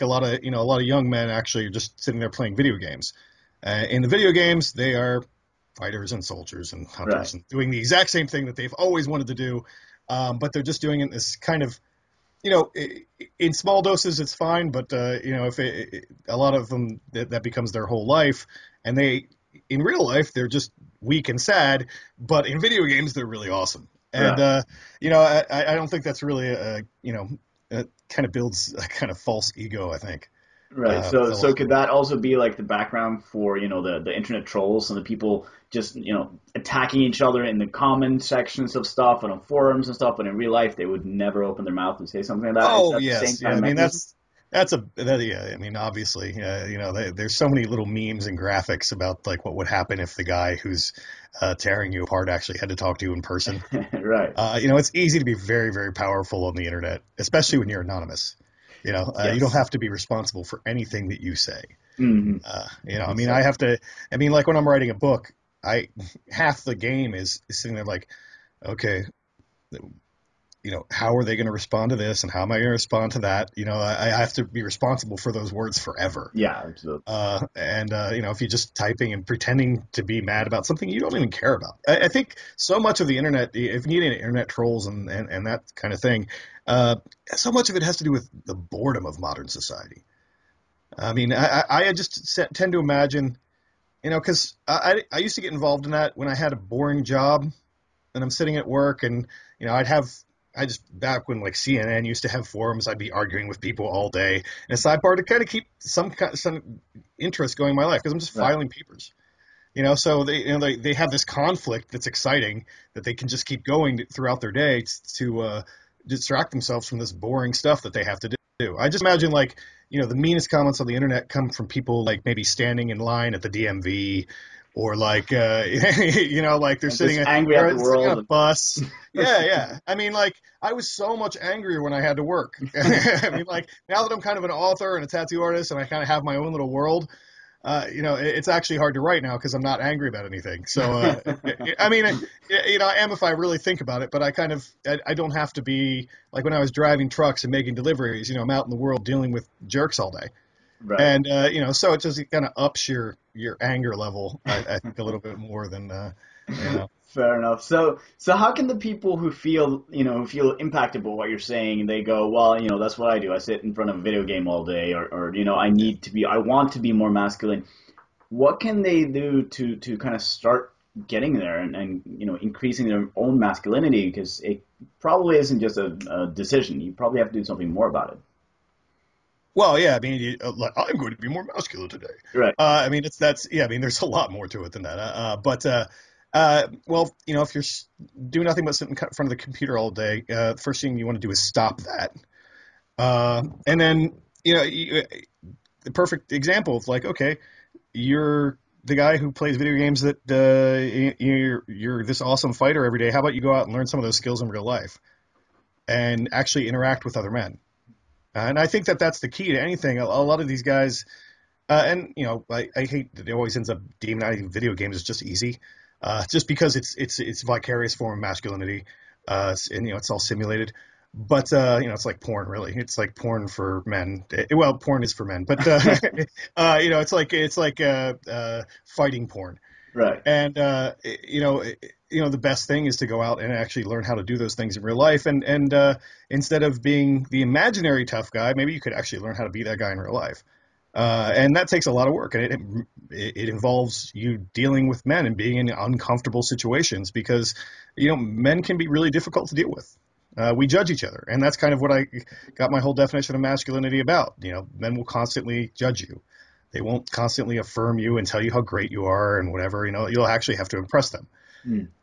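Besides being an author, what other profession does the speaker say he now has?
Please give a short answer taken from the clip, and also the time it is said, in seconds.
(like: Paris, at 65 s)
Tattoo artist, at 135 s.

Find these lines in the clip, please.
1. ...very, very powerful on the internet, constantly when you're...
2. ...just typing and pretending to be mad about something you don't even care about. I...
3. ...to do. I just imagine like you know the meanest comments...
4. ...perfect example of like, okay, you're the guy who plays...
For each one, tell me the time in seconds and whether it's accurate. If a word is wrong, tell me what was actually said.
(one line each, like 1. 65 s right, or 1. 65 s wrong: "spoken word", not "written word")
1. 55 s wrong: "especially", not "constantly"
2. 78 s right
3. 118 s right
4. 195 s right.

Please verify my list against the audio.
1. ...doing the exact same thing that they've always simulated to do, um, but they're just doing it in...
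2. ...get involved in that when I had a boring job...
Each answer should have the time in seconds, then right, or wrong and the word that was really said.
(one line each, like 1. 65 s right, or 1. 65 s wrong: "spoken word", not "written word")
1. 7 s wrong: "wanted", not "simulated"
2. 95 s right.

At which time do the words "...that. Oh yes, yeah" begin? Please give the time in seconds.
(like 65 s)
42 s.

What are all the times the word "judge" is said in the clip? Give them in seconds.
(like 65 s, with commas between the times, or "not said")
250 s, 255 s.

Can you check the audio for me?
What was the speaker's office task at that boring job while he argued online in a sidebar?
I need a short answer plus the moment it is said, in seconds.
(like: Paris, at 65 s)
Filing papers, at 108 s.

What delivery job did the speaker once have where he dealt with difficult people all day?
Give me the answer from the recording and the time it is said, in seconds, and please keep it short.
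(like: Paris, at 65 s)
Driving trucks, at 146 s.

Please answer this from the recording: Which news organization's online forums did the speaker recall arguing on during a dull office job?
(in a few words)
CNN.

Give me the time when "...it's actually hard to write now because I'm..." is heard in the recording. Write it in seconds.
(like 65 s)
138 s.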